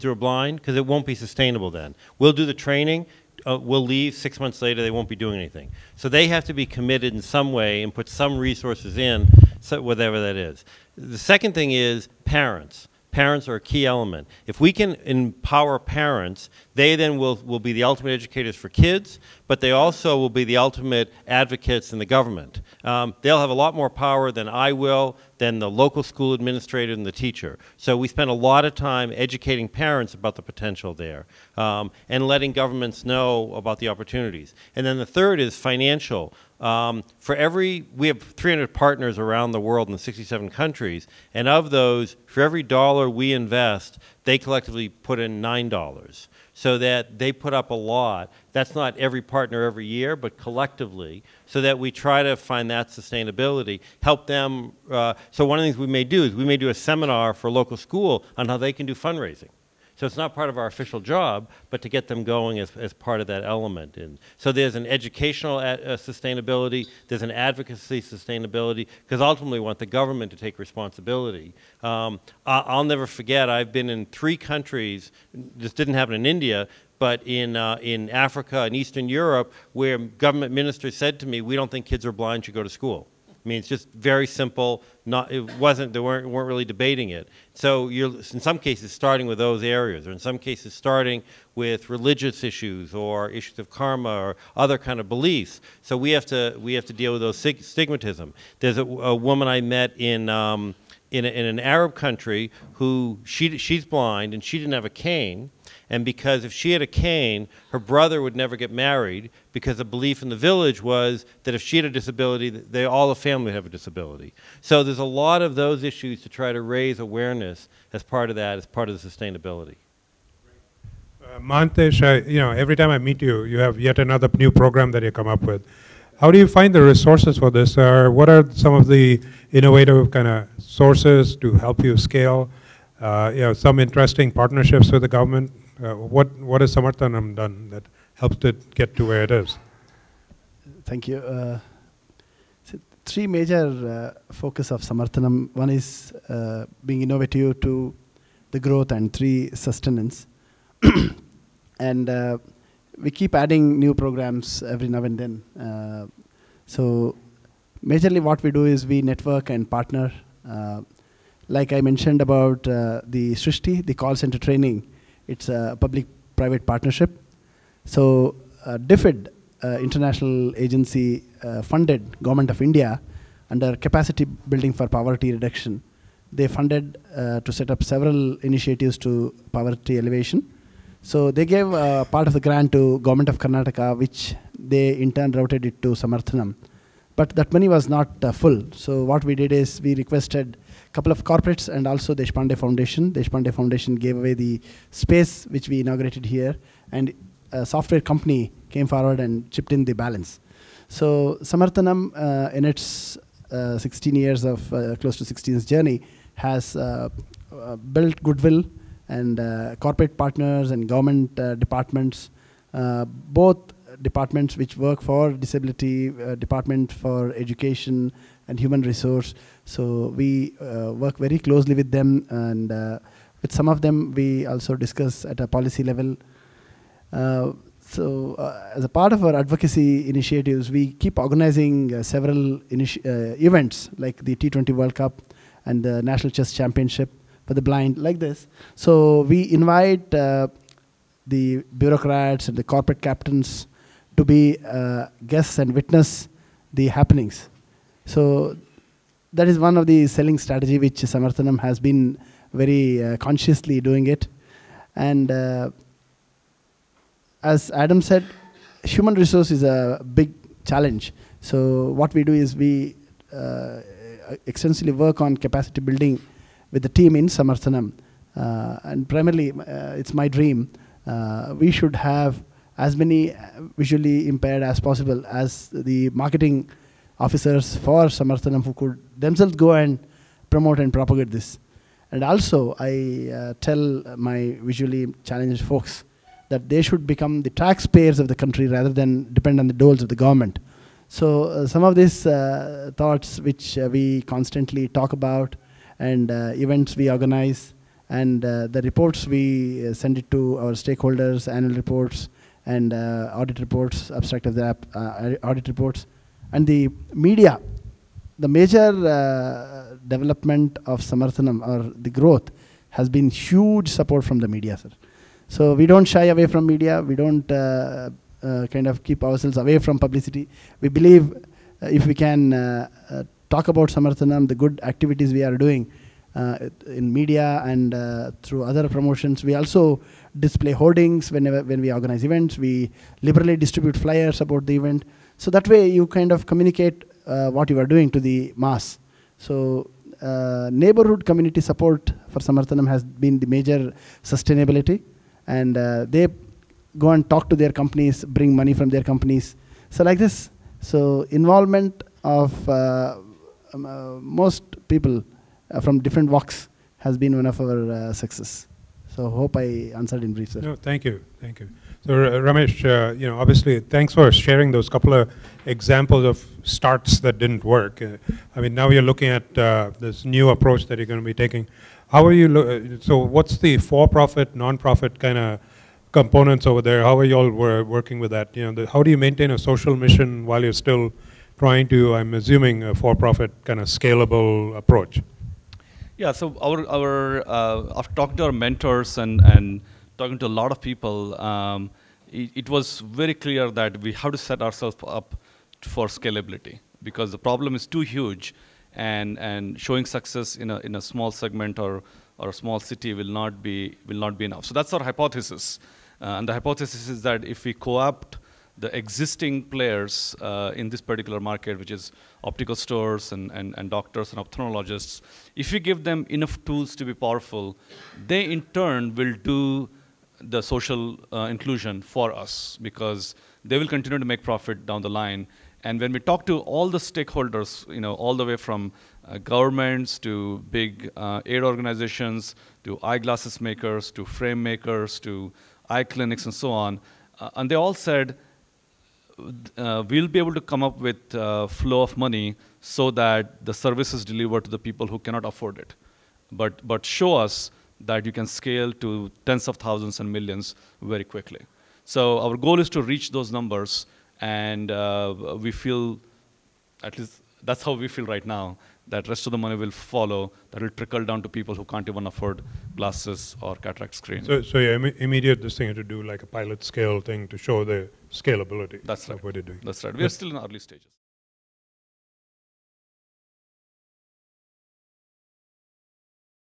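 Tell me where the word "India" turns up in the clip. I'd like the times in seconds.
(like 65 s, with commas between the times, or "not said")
76 s, 172 s.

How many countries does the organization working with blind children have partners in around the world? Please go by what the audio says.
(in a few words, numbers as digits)
67.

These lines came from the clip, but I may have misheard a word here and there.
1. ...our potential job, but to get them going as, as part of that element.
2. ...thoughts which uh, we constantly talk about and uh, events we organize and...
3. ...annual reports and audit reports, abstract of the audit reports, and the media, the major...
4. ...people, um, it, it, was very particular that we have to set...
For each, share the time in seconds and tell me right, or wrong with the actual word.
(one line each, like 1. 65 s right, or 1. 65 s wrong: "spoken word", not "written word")
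1. 60 s wrong: "official", not "potential"
2. 292 s right
3. 301 s right
4. 390 s wrong: "clear", not "particular".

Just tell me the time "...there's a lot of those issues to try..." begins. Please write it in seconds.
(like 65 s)
114 s.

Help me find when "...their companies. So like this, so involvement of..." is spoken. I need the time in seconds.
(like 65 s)
348 s.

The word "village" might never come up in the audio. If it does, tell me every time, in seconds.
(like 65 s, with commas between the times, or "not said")
110 s.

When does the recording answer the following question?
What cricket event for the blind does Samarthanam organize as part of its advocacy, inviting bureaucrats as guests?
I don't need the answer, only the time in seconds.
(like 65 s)
234 s.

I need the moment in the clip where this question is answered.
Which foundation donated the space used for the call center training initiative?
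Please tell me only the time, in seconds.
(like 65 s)
193 s.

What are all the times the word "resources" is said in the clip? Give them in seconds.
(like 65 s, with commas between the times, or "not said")
8 s, 126 s, 218 s, 259 s.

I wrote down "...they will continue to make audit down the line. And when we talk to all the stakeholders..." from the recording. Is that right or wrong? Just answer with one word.
wrong.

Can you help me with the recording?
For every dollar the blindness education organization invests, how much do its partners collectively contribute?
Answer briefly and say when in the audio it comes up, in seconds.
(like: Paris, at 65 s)
$9, at 45 s.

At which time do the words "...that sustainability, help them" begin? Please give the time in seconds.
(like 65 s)
52 s.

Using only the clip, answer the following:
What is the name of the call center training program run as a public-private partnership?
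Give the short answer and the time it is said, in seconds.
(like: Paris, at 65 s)
Srishti, at 163 s.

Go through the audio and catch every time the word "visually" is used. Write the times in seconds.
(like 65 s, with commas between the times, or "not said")
273 s, 284 s.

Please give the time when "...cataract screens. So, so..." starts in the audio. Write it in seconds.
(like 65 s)
463 s.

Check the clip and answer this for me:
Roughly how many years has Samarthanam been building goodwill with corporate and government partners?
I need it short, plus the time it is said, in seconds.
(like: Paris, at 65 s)
16 years, at 204 s.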